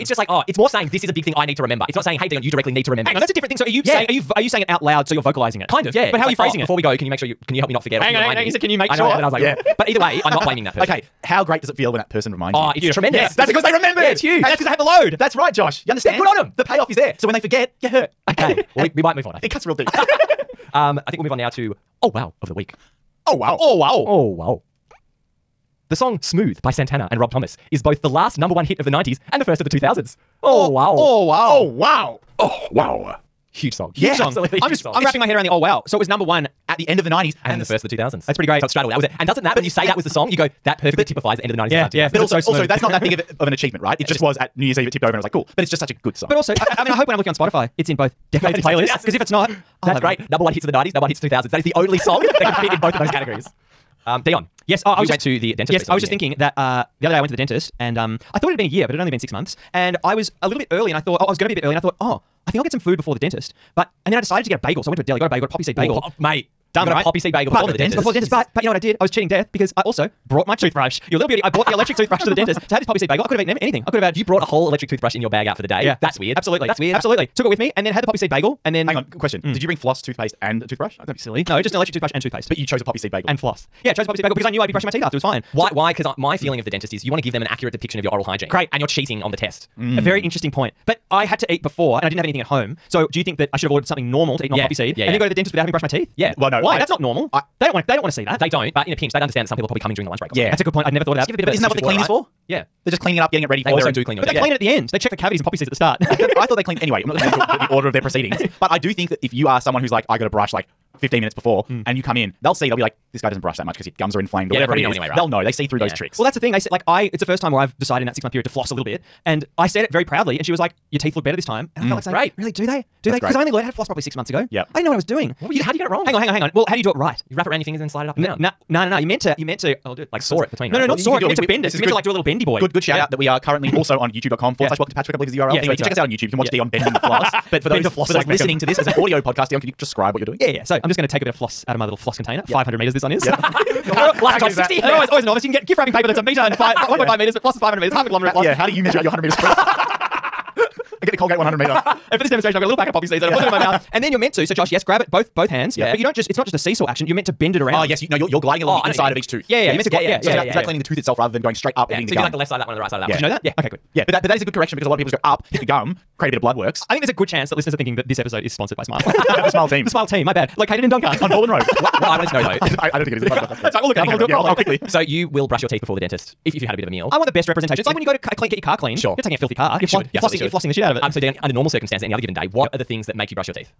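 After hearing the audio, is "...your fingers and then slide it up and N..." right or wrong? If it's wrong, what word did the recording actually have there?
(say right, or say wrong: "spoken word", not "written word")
right.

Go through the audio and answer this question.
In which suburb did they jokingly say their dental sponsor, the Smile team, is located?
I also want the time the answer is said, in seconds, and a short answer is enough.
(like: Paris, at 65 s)
Doncaster, at 170 s.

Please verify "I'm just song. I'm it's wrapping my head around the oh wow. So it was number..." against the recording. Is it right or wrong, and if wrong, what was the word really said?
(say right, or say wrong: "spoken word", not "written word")
right.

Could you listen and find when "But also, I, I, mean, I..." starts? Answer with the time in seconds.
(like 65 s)
46 s.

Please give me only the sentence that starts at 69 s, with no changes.
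I was cheating death because I also brought my toothbrush.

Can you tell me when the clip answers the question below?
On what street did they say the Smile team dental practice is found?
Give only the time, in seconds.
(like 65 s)
171 s.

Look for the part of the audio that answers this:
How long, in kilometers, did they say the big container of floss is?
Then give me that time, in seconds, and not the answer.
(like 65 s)
147 s.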